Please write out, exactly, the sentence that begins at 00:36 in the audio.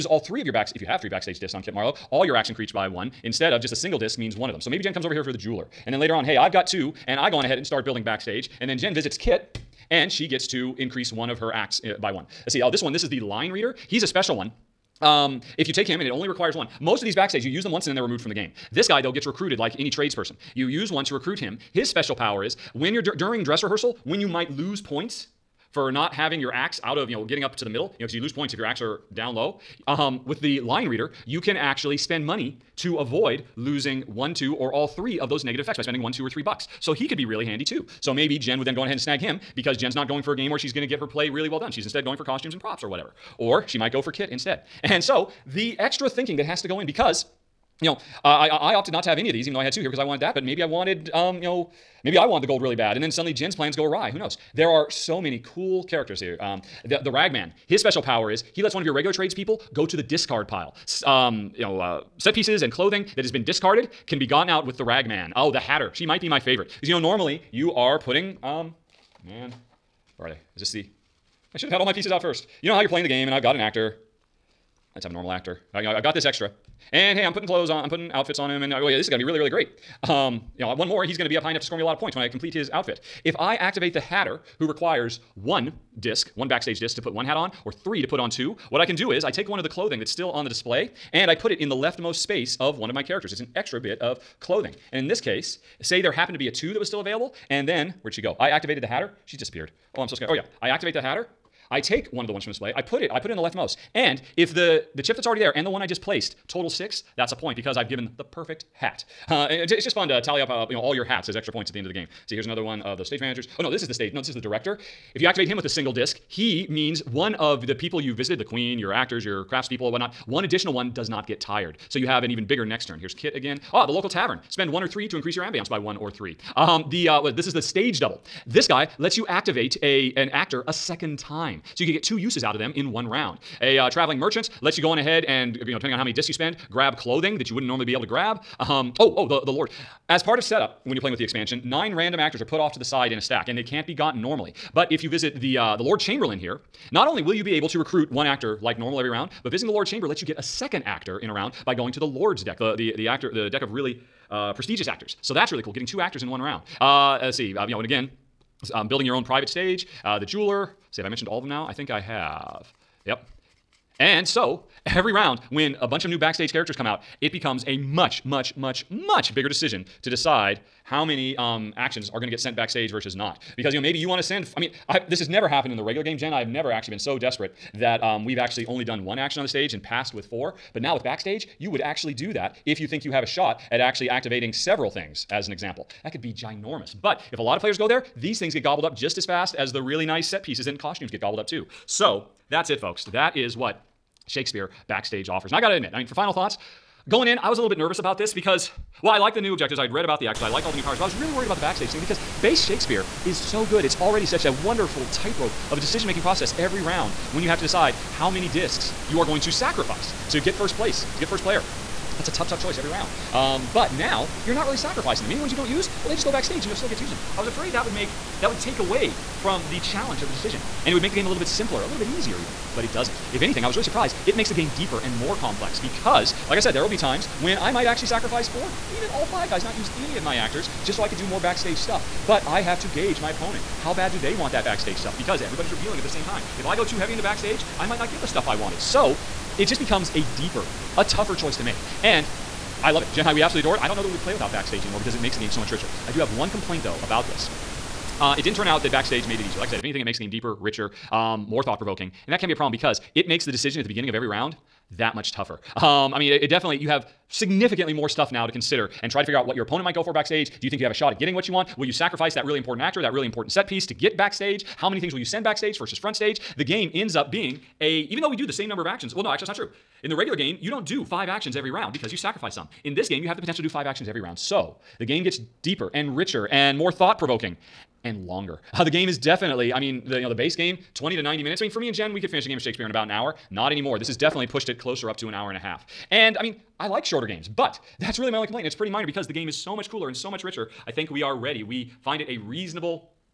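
So he could be really handy too.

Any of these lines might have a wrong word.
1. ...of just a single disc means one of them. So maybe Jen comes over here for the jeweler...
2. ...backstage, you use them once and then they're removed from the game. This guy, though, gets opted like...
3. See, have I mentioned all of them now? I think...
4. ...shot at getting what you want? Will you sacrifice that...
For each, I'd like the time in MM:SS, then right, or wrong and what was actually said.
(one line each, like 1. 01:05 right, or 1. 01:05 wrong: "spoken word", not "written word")
1. 00:03 right
2. 00:17 wrong: "recruited", not "opted"
3. 02:40 right
4. 04:20 right.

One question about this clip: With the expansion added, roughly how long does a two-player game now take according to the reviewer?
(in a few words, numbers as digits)
An hour and a half.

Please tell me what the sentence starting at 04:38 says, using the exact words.
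Uh, the game is definitely, I mean, the you know the base game, 20 to 90 minutes.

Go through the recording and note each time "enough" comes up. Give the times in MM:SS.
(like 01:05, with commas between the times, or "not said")
01:21.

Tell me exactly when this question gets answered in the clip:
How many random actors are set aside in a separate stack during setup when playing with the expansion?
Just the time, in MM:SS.
02:21.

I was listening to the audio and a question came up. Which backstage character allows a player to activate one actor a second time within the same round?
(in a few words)
The stage double.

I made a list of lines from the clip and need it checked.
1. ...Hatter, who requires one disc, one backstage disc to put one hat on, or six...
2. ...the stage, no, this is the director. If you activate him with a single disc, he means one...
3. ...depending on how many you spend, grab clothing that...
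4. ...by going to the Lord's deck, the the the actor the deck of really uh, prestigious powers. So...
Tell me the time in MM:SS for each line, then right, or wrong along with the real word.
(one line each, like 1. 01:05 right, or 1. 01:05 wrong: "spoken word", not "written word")
1. 01:23 wrong: "three", not "six"
2. 01:53 right
3. 02:15 right
4. 02:31 wrong: "actors", not "powers".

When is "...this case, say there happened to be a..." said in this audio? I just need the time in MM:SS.
01:35.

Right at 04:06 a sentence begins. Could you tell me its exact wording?
I do have one complaint, though, about this.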